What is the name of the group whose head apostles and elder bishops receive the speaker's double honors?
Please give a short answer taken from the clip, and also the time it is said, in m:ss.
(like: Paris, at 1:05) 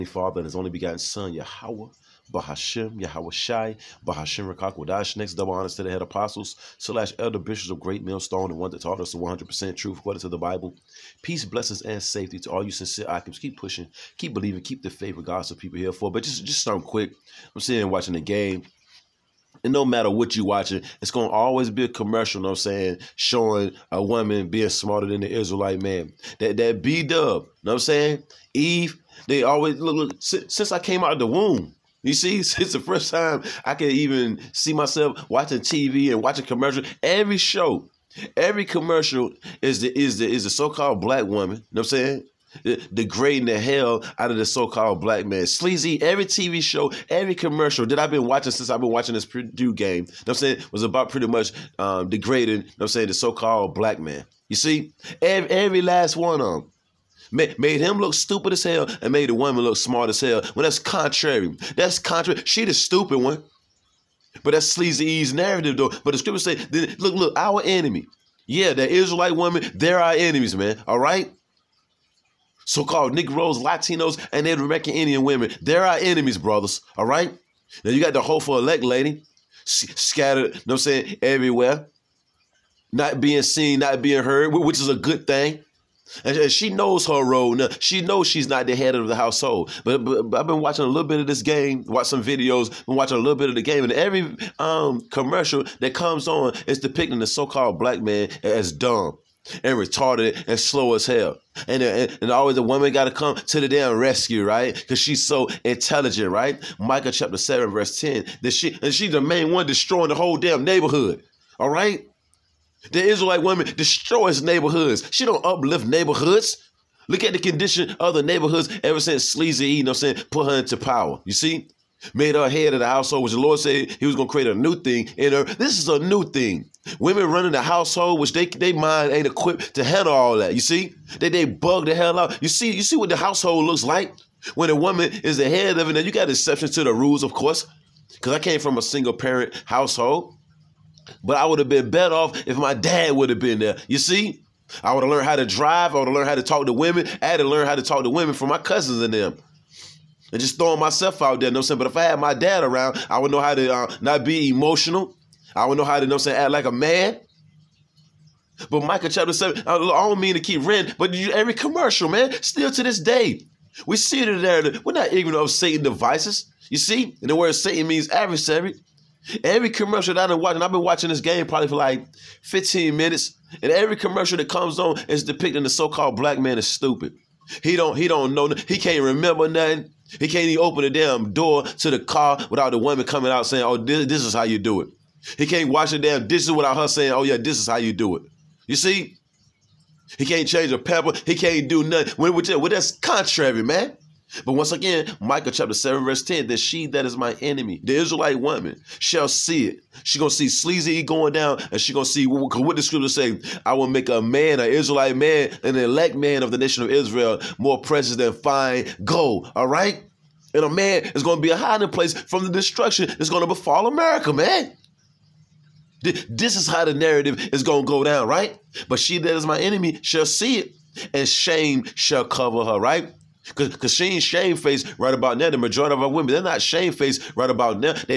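Great Millstone, at 0:07.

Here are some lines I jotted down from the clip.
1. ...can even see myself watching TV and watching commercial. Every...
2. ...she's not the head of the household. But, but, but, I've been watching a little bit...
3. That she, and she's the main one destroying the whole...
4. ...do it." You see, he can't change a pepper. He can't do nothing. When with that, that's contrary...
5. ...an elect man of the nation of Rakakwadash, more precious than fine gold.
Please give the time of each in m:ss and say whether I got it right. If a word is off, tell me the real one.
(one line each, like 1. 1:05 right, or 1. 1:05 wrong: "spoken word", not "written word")
1. 0:33 right
2. 1:28 right
3. 1:48 right
4. 3:07 right
5. 3:25 wrong: "Israel", not "Rakakwadash".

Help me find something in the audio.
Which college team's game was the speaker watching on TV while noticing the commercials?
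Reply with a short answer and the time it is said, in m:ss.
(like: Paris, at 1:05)
Purdue, at 0:49.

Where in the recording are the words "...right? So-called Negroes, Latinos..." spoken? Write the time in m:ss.
1:10.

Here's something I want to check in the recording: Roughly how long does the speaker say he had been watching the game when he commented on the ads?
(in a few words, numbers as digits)
15 minutes.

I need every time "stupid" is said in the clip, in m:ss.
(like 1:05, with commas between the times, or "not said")
0:58, 1:02, 2:56.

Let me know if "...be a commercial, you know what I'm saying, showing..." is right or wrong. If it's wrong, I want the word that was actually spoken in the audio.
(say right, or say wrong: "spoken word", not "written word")
right.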